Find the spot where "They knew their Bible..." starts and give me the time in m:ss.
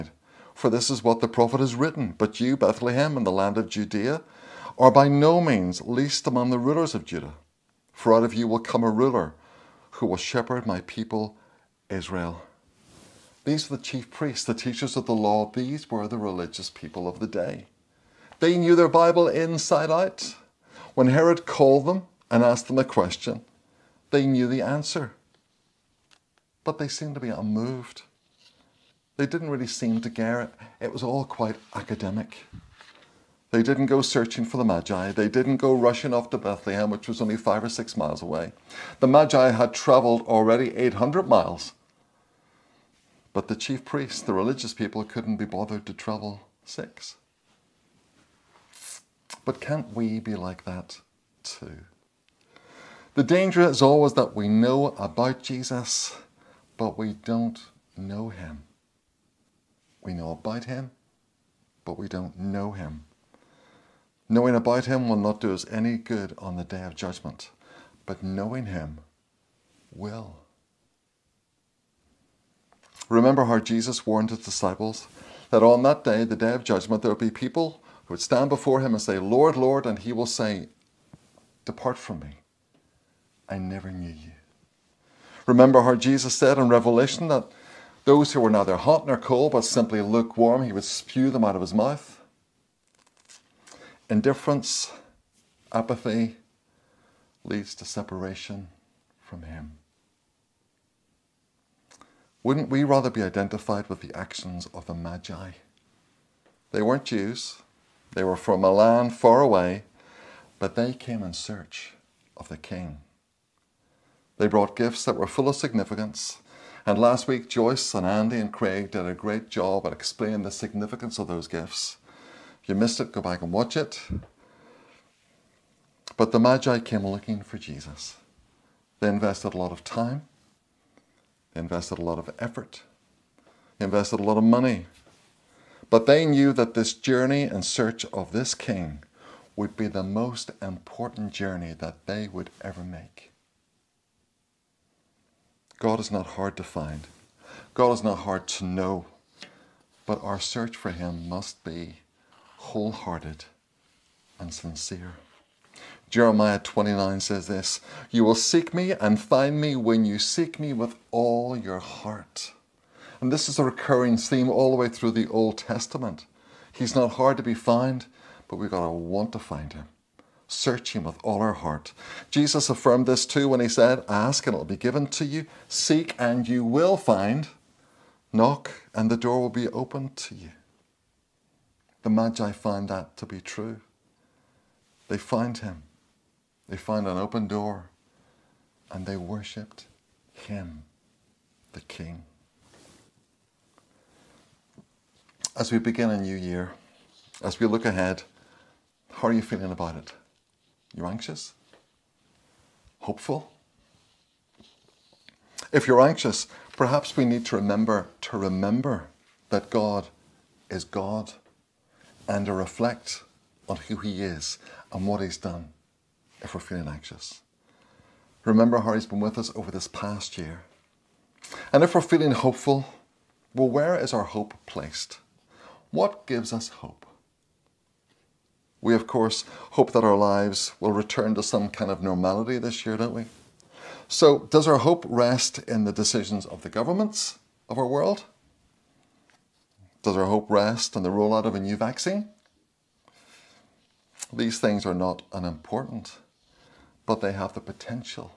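0:18.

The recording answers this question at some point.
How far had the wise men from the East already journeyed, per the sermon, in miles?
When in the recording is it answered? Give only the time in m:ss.
0:40.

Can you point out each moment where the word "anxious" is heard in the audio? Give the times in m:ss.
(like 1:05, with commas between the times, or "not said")
3:21, 3:26, 3:36.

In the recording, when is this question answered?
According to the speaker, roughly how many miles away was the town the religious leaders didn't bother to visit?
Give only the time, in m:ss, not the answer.
0:37.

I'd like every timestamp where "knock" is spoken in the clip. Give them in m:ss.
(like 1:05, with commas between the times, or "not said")
2:58.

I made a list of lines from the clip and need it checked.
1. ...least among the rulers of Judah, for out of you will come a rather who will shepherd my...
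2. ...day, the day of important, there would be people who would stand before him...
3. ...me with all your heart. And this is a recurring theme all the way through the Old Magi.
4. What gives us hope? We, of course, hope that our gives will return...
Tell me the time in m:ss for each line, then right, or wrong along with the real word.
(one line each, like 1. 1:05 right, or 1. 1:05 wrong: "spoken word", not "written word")
1. 0:05 wrong: "ruler", not "rather"
2. 1:16 wrong: "judgment", not "important"
3. 2:40 wrong: "Testament", not "Magi"
4. 3:45 wrong: "lives", not "gives".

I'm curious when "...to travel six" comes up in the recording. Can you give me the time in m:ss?
0:45.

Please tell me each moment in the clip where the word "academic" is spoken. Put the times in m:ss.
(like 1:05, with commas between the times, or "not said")
0:31.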